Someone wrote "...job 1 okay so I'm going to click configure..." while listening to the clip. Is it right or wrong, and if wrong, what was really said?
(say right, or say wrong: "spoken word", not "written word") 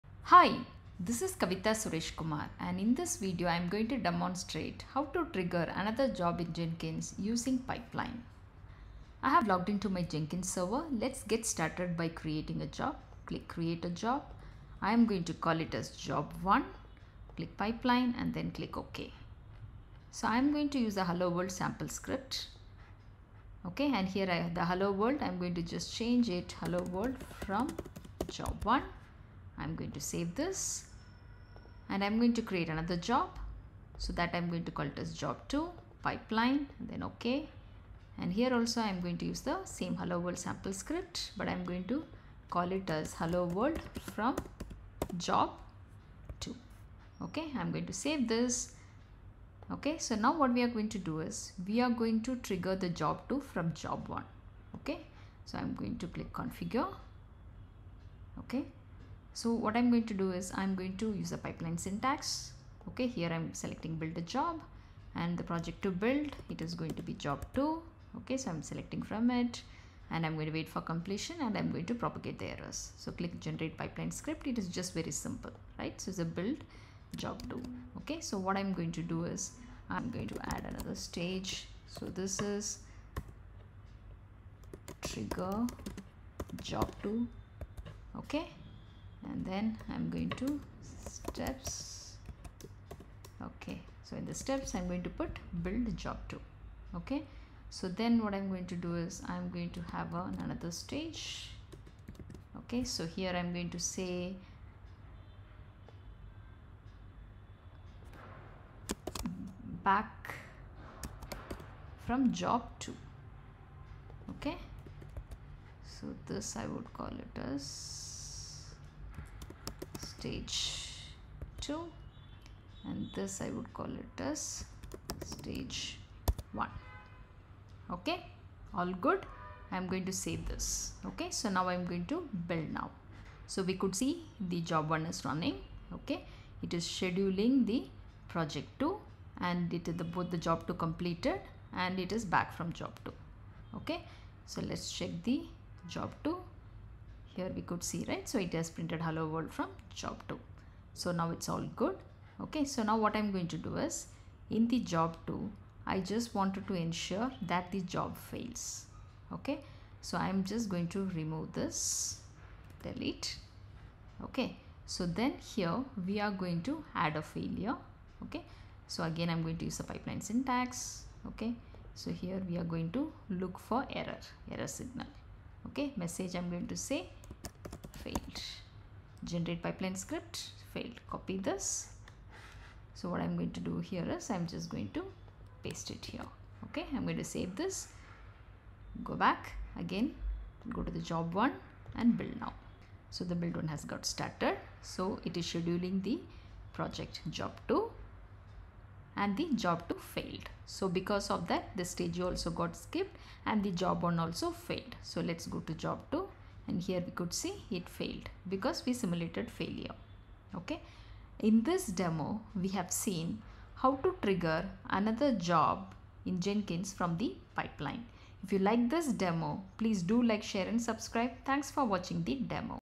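right.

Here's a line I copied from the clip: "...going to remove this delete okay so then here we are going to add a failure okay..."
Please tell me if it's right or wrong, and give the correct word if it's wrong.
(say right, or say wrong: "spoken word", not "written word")
right.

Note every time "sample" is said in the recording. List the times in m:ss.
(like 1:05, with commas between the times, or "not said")
0:21, 0:40.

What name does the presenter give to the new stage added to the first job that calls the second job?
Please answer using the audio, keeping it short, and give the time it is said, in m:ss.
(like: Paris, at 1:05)
trigger job two, at 1:25.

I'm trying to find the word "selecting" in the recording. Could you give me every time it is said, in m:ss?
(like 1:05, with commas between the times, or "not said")
1:03, 1:08.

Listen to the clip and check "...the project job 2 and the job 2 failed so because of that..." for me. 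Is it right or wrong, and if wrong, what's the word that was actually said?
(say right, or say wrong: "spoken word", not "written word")
right.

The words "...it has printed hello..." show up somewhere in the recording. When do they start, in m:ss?
2:28.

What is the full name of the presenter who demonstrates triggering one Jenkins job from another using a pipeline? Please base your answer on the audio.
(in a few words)
Kavitha Suresh Kumar.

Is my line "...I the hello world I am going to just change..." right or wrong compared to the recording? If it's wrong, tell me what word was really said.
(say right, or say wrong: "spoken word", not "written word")
right.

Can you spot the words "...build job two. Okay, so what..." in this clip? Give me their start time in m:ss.
1:16.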